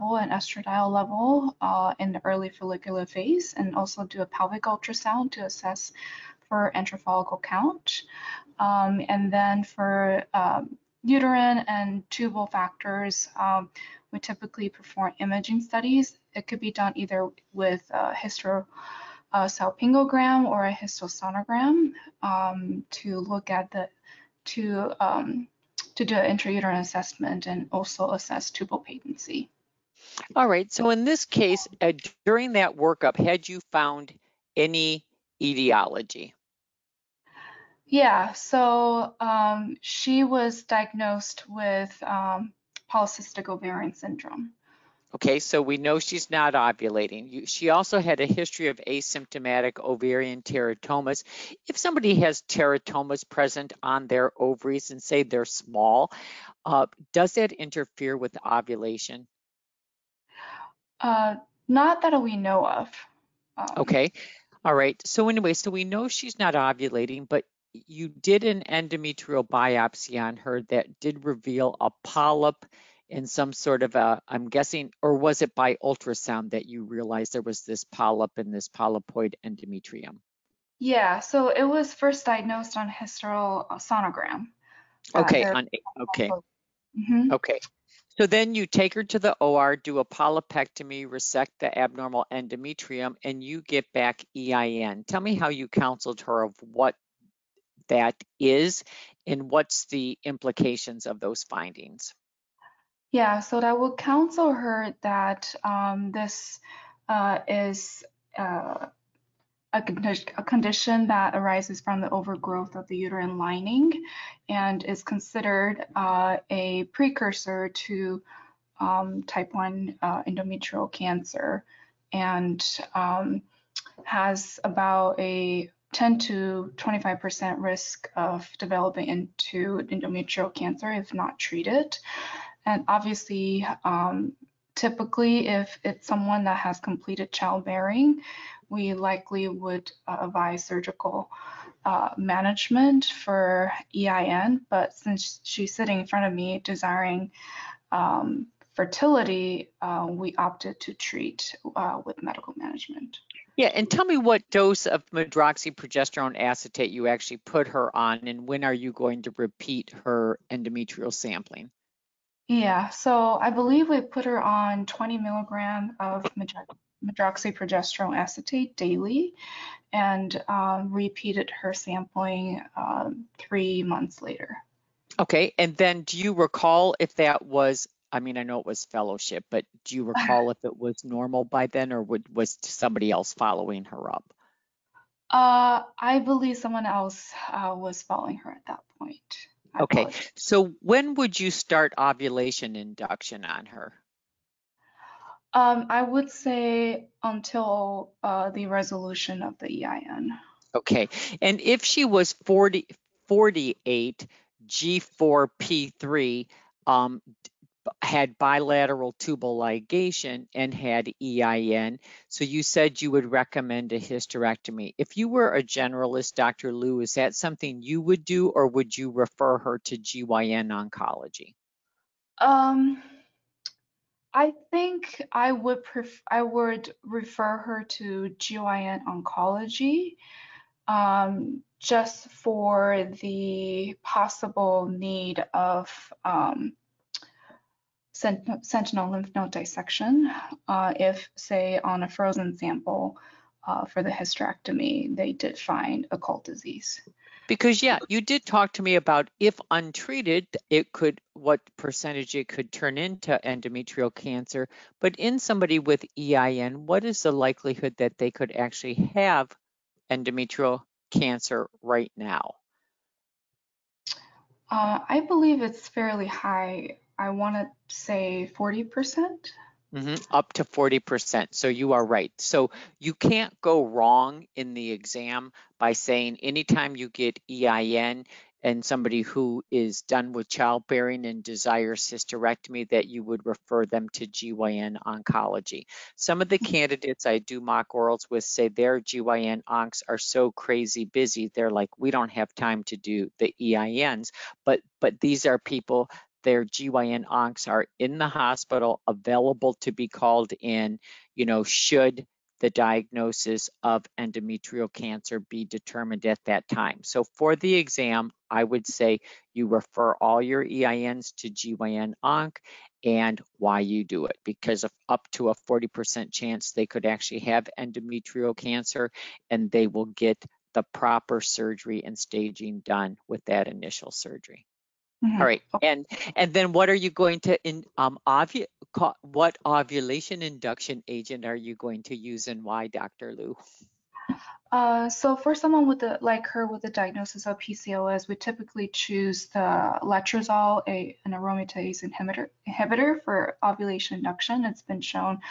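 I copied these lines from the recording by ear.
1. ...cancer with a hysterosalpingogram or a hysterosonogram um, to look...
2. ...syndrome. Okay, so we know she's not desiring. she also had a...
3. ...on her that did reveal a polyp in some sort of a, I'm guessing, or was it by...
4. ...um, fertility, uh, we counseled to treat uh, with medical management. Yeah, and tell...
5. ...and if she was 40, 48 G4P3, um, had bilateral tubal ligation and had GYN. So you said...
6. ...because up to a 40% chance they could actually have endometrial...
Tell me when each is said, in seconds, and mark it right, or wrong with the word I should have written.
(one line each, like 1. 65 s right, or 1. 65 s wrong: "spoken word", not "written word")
1. 16 s wrong: "either", not "cancer"
2. 43 s wrong: "ovulating", not "desiring"
3. 70 s right
4. 147 s wrong: "opted", not "counseled"
5. 201 s wrong: "EIN", not "GYN"
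6. 314 s right.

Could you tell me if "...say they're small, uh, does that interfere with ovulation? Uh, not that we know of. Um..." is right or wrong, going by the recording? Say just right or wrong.
right.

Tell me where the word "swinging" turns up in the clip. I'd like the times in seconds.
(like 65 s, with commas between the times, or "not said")
not said.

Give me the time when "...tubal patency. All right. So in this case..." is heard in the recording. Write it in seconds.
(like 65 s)
28 s.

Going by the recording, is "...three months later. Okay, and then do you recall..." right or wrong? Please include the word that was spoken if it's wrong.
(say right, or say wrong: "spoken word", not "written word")
right.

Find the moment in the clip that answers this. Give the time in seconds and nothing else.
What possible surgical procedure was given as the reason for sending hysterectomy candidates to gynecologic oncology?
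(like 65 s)
238 s.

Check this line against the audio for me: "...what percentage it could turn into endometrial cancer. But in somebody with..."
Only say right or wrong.
right.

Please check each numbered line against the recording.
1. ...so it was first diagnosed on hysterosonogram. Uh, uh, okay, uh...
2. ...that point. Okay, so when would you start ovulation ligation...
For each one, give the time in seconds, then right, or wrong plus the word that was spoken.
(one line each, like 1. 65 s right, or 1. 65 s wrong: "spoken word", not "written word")
1. 81 s right
2. 188 s wrong: "induction", not "ligation".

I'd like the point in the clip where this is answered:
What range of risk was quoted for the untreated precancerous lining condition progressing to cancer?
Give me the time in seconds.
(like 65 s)
125 s.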